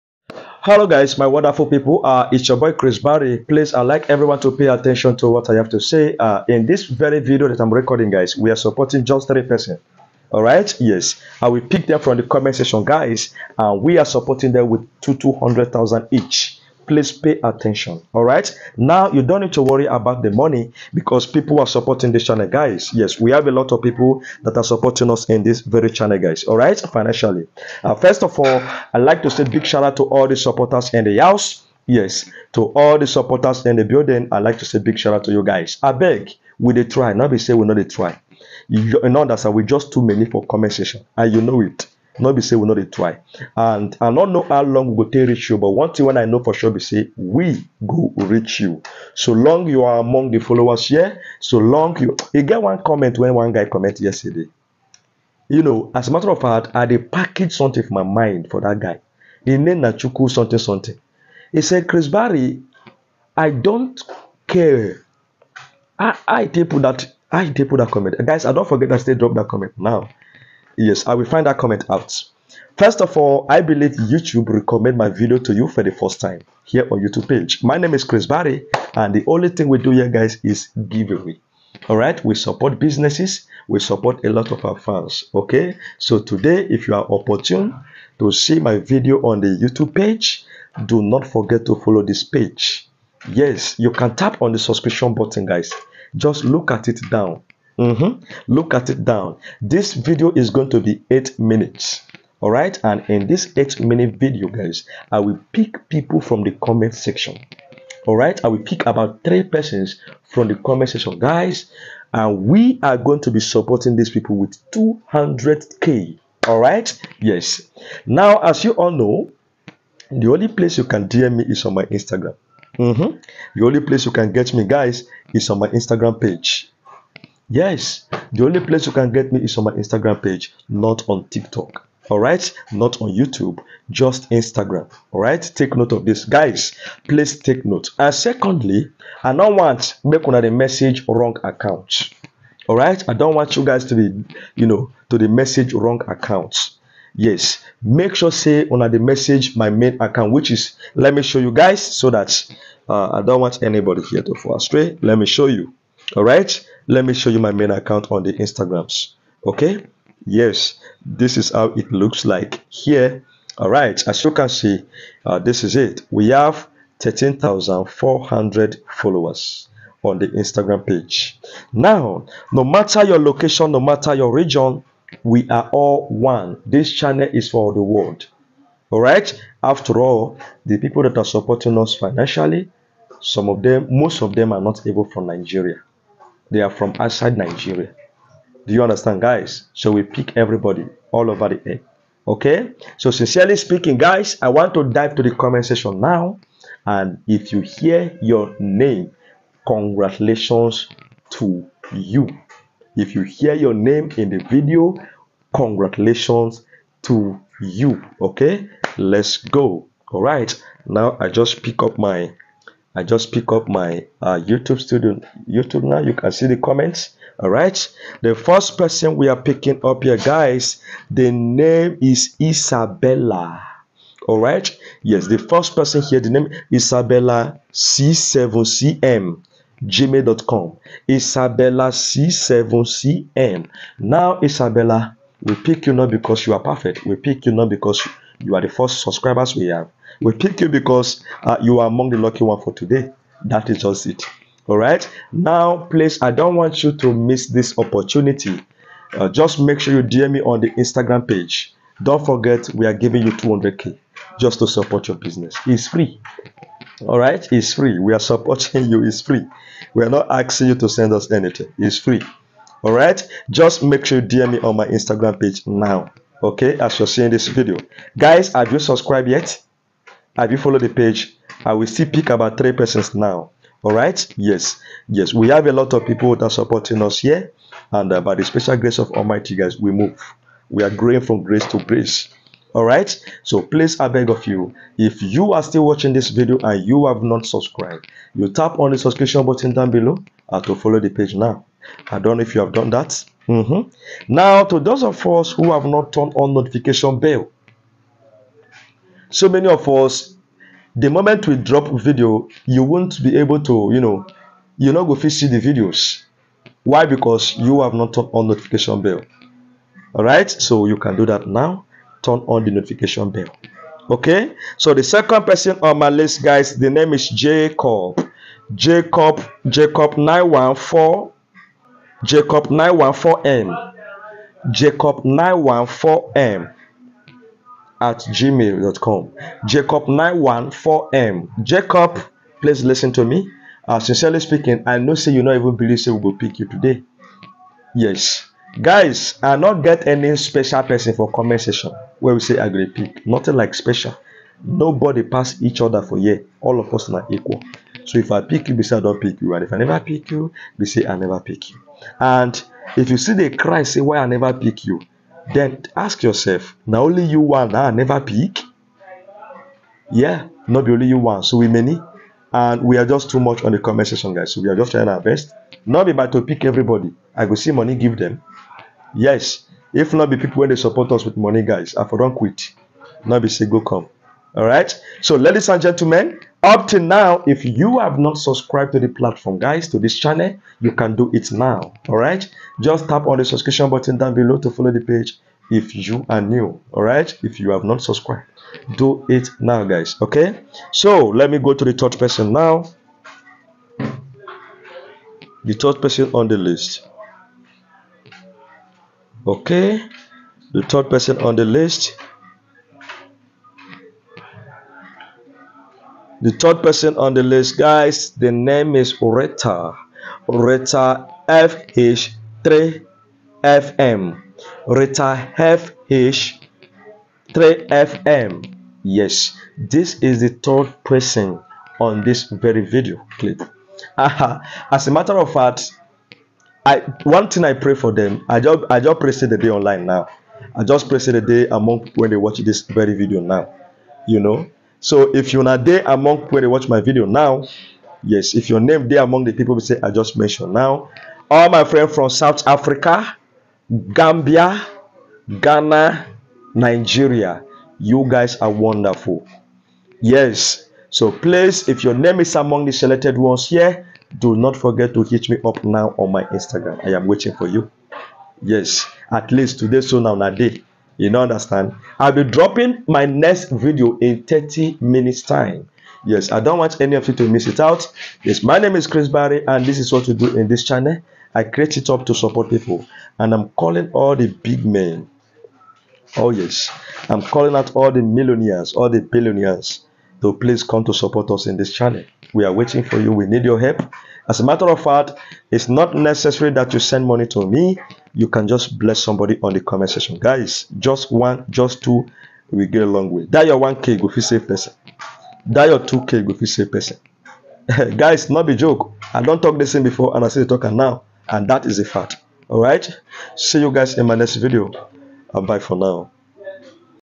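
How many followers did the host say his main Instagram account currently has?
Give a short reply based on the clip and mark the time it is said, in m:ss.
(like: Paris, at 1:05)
13,400, at 2:46.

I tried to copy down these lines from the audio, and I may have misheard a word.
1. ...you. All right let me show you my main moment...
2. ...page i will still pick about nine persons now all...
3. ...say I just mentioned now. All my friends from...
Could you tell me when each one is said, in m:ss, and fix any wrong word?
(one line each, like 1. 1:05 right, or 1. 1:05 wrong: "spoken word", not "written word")
1. 2:35 wrong: "account", not "moment"
2. 4:30 wrong: "three", not "nine"
3. 7:19 right.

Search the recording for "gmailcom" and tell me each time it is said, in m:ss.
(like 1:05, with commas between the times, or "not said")
3:49, 5:28.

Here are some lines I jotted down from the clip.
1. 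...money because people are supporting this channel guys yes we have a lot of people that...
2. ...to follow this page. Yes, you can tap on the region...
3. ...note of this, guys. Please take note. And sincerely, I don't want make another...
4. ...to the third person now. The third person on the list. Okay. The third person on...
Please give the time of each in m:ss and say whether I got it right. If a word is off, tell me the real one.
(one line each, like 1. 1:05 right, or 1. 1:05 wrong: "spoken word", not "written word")
1. 0:20 right
2. 1:31 wrong: "subscription", not "region"
3. 2:15 wrong: "secondly", not "sincerely"
4. 6:31 right.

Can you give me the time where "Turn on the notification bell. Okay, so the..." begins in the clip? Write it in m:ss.
5:12.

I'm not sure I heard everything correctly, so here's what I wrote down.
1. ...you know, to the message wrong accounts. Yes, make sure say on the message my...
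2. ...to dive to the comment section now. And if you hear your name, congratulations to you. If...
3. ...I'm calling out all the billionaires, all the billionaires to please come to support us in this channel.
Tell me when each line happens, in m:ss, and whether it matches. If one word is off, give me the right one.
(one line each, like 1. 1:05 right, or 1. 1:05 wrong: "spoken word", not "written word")
1. 2:24 right
2. 3:14 right
3. 7:57 wrong: "millionaires", not "billionaires".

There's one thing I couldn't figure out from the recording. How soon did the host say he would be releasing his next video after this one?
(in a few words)
30 minutes.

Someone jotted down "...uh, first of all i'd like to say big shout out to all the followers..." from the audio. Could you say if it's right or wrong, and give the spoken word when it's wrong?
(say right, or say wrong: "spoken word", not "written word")
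wrong: "supporters", not "followers".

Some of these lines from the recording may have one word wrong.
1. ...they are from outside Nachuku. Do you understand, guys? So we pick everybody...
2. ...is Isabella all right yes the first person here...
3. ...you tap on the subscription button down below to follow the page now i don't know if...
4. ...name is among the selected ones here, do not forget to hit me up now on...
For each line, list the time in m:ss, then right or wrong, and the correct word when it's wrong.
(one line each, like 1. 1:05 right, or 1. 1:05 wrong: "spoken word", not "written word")
1. 3:06 wrong: "Nigeria", not "Nachuku"
2. 3:42 right
3. 4:48 right
4. 7:32 right.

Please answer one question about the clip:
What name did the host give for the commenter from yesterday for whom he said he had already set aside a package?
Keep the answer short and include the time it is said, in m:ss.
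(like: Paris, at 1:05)
Nachuku, at 0:59.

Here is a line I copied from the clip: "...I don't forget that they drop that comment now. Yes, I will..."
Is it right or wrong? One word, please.
right.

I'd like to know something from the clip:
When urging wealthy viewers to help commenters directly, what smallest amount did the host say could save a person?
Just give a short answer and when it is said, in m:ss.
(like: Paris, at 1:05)
1k, at 8:13.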